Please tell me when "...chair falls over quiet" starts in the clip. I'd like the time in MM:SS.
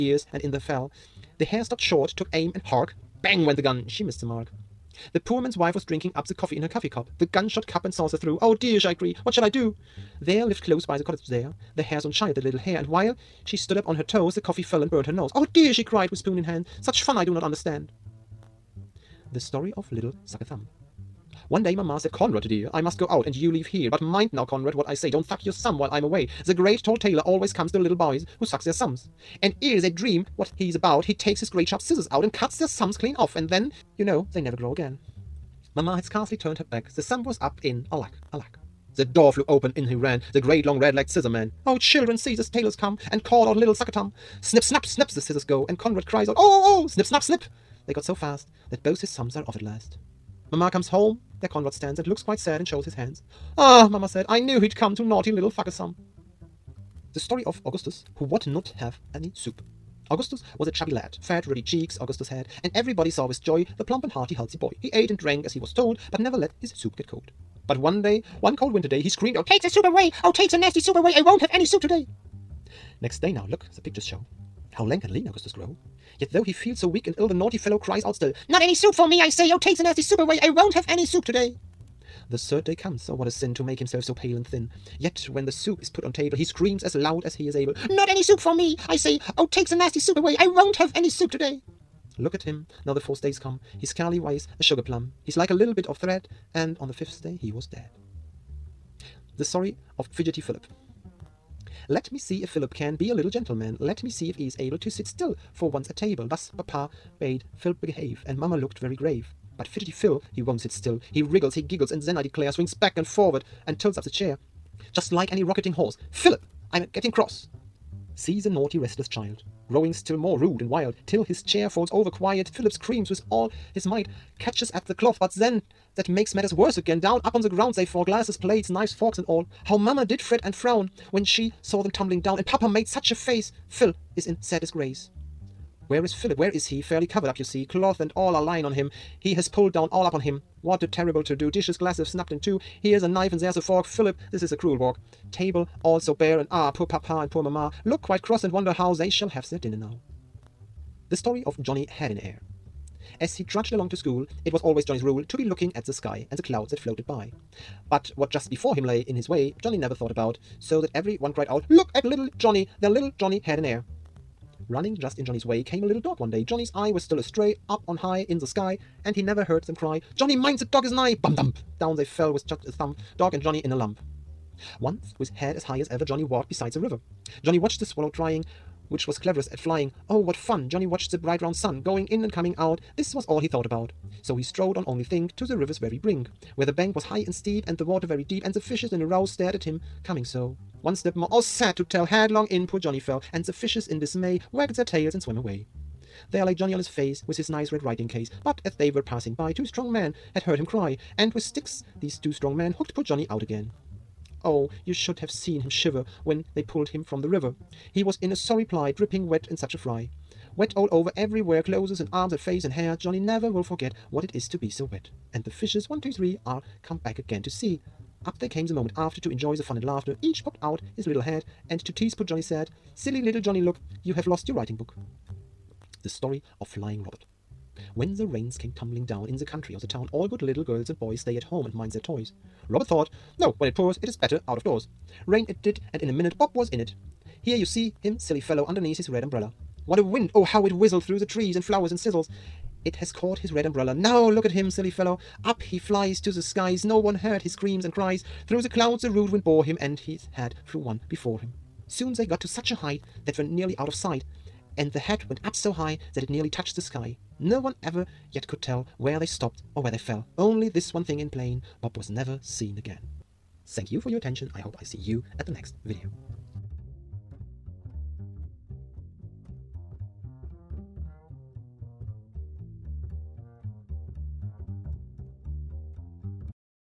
02:01.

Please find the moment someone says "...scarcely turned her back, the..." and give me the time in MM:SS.
00:36.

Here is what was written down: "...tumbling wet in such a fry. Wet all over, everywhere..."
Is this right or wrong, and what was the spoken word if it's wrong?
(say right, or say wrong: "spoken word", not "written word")
wrong: "dripping", not "tumbling".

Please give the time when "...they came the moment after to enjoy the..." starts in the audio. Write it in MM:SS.
03:38.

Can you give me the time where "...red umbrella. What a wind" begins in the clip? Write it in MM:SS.
03:59.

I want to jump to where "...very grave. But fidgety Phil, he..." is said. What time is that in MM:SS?
01:48.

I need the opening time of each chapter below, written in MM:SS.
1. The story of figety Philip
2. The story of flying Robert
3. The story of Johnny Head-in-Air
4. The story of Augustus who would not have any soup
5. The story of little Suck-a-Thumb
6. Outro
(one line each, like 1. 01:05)
1. 01:38
2. 03:44
3. 02:30
4. 00:56
5. 00:18
6. 04:23.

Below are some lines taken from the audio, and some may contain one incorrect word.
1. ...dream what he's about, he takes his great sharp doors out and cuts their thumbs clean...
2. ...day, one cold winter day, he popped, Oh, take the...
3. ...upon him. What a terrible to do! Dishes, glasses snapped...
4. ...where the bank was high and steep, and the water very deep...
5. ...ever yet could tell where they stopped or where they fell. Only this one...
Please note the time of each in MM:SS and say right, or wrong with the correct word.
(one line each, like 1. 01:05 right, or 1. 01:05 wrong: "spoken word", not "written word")
1. 00:29 wrong: "scissors", not "doors"
2. 01:08 wrong: "screamed", not "popped"
3. 02:20 right
4. 03:06 right
5. 04:17 right.